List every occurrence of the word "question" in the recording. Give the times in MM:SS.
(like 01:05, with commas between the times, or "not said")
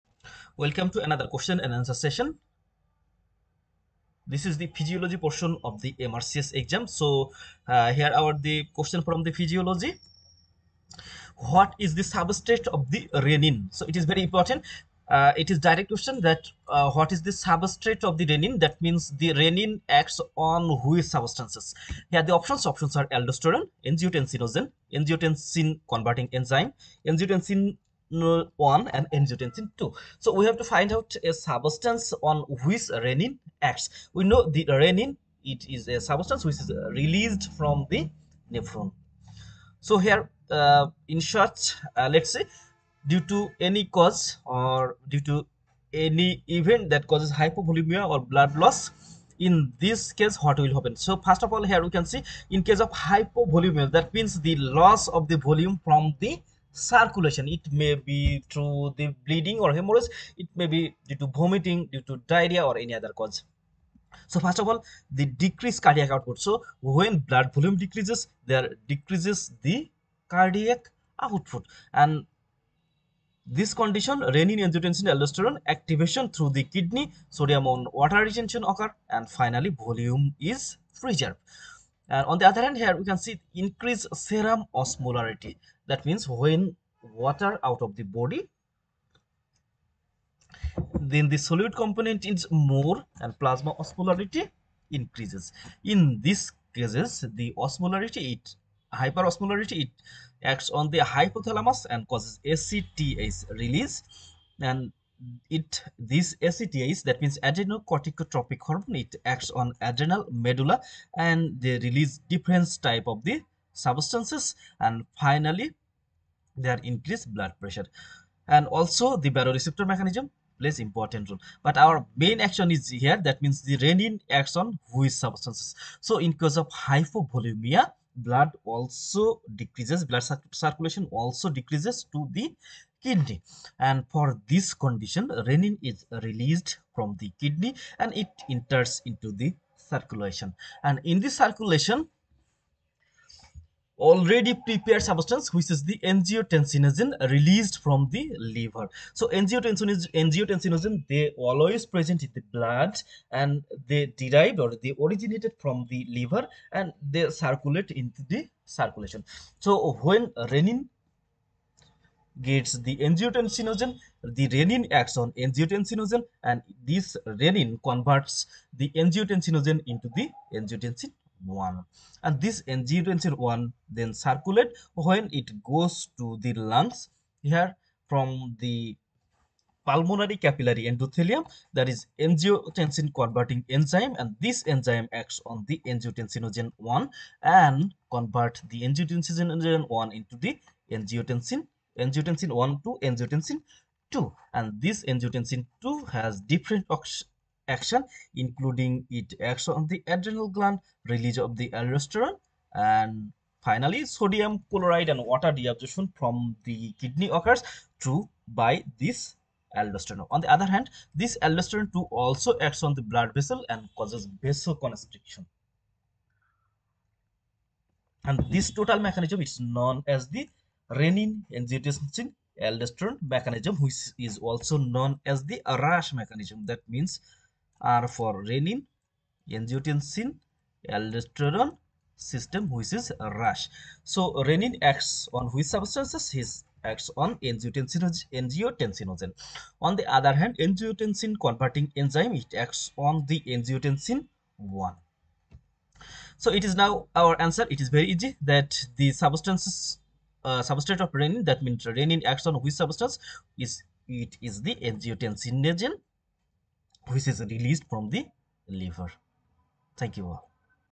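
00:01, 00:08, 00:15.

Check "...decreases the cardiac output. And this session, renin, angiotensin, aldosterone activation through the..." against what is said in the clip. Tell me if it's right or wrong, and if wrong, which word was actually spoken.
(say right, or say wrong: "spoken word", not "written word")
wrong: "condition", not "session".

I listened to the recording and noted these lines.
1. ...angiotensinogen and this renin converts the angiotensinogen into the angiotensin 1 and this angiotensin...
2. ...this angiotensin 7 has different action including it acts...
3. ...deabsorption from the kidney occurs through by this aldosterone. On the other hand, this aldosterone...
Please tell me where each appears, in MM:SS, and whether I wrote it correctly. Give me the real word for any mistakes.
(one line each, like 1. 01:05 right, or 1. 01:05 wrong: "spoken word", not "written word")
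1. 02:45 right
2. 03:14 wrong: "2", not "7"
3. 03:25 right.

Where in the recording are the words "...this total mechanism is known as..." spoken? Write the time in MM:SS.
03:38.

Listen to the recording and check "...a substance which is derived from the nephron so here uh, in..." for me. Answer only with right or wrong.
wrong.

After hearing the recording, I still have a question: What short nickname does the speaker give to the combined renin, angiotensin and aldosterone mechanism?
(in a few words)
RAS mechanism.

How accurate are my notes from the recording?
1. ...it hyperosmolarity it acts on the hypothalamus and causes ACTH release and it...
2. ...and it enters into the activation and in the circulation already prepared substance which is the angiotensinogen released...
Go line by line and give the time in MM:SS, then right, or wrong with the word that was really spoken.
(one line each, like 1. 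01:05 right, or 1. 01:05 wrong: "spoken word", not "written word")
1. 01:38 right
2. 02:17 wrong: "circulation", not "activation".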